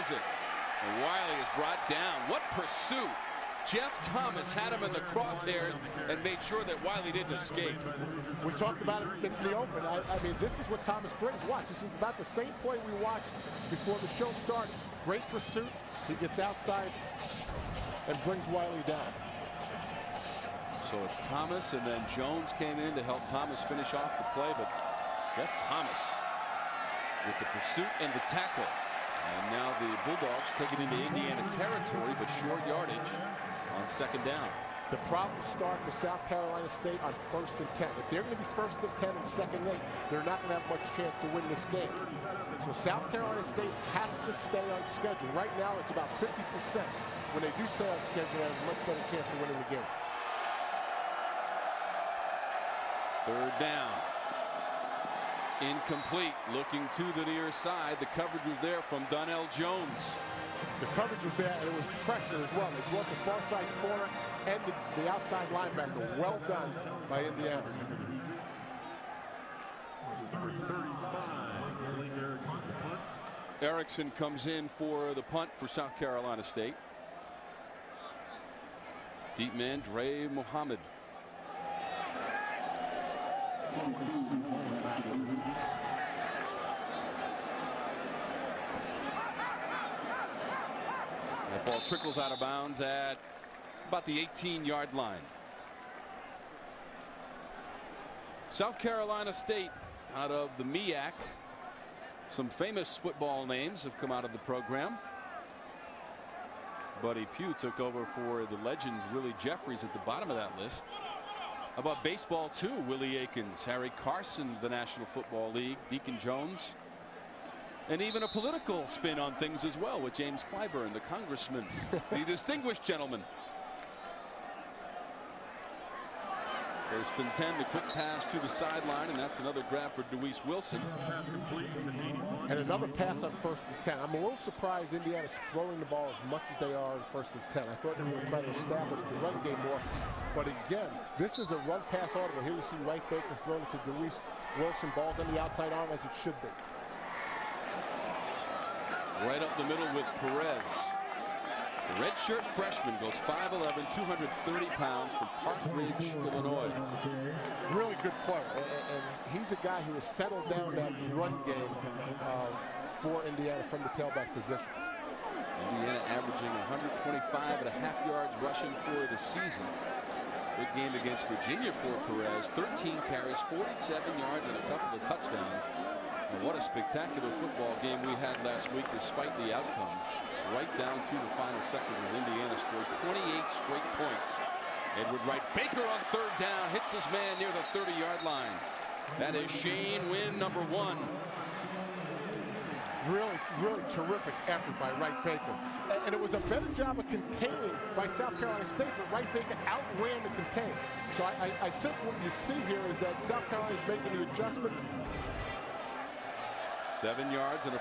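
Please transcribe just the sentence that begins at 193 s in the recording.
Really, really terrific effort by Wright Baker.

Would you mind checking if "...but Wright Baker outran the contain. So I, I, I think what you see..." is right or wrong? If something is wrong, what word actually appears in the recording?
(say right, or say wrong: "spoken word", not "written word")
right.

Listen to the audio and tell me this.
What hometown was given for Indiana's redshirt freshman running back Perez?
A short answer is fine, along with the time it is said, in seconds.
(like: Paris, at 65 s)
Park Ridge, Illinois, at 155 s.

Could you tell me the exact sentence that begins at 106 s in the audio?
Buddy Pugh took over for the legend Willie Jeffries at the bottom of that list about baseball too.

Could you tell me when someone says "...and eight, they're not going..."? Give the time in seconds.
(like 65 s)
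39 s.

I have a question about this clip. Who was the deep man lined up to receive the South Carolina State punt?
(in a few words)
Dre Muhammad.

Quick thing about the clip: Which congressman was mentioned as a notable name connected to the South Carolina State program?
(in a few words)
James Clyburn.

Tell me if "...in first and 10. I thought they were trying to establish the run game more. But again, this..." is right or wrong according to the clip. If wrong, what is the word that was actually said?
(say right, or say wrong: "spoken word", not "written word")
right.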